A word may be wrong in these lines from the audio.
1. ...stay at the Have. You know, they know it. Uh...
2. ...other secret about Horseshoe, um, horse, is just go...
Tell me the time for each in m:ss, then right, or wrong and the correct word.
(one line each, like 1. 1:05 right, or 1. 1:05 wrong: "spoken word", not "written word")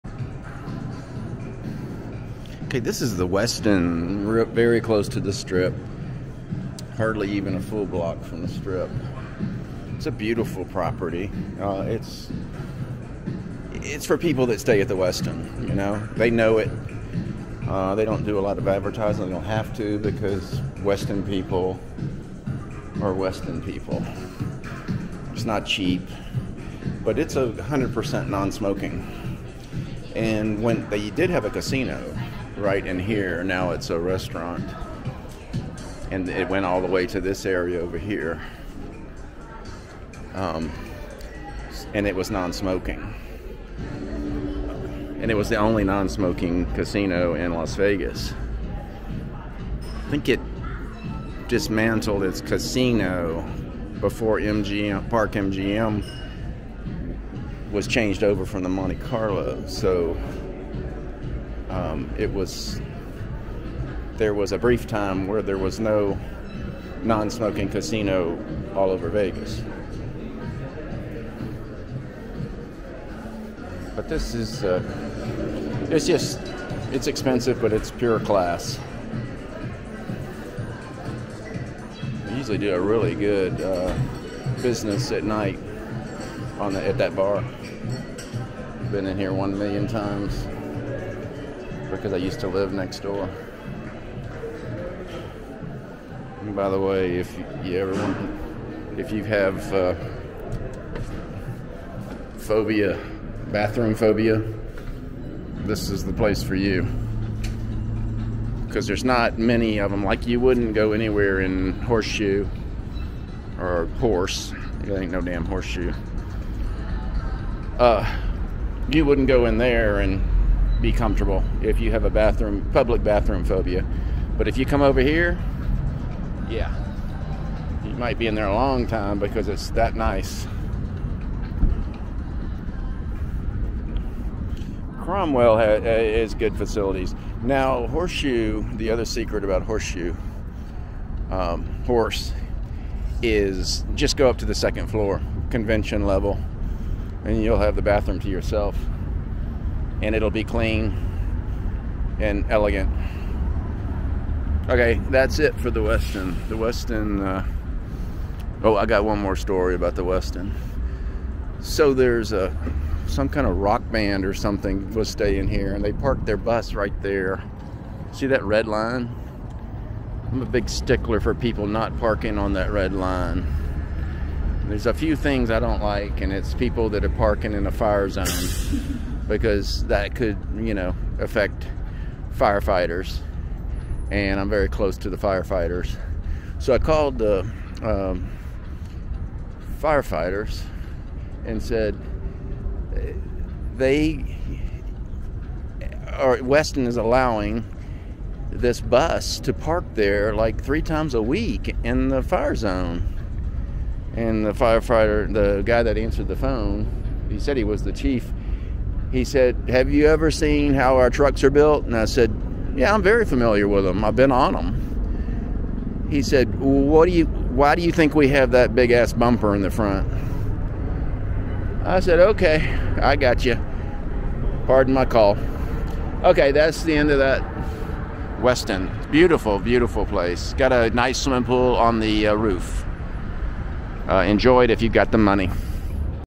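1. 0:14 wrong: "Westin", not "Have"
2. 2:18 right.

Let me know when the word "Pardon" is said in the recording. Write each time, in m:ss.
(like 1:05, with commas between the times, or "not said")
3:44.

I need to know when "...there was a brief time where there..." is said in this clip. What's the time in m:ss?
1:04.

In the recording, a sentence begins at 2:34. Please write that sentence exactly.
Okay, that's it for the Westin.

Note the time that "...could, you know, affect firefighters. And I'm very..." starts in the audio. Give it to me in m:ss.
3:00.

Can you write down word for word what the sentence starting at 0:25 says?
It's not cheap, but it's a 100% non-smoking.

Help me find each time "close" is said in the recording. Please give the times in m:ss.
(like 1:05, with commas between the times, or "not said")
0:04, 3:04.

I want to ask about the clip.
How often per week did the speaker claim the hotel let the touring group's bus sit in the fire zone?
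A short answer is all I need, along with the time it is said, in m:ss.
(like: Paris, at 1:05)
3 times, at 3:20.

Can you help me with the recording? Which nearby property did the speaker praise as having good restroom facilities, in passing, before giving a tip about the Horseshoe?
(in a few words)
Cromwell.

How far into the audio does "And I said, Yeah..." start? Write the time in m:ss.
3:31.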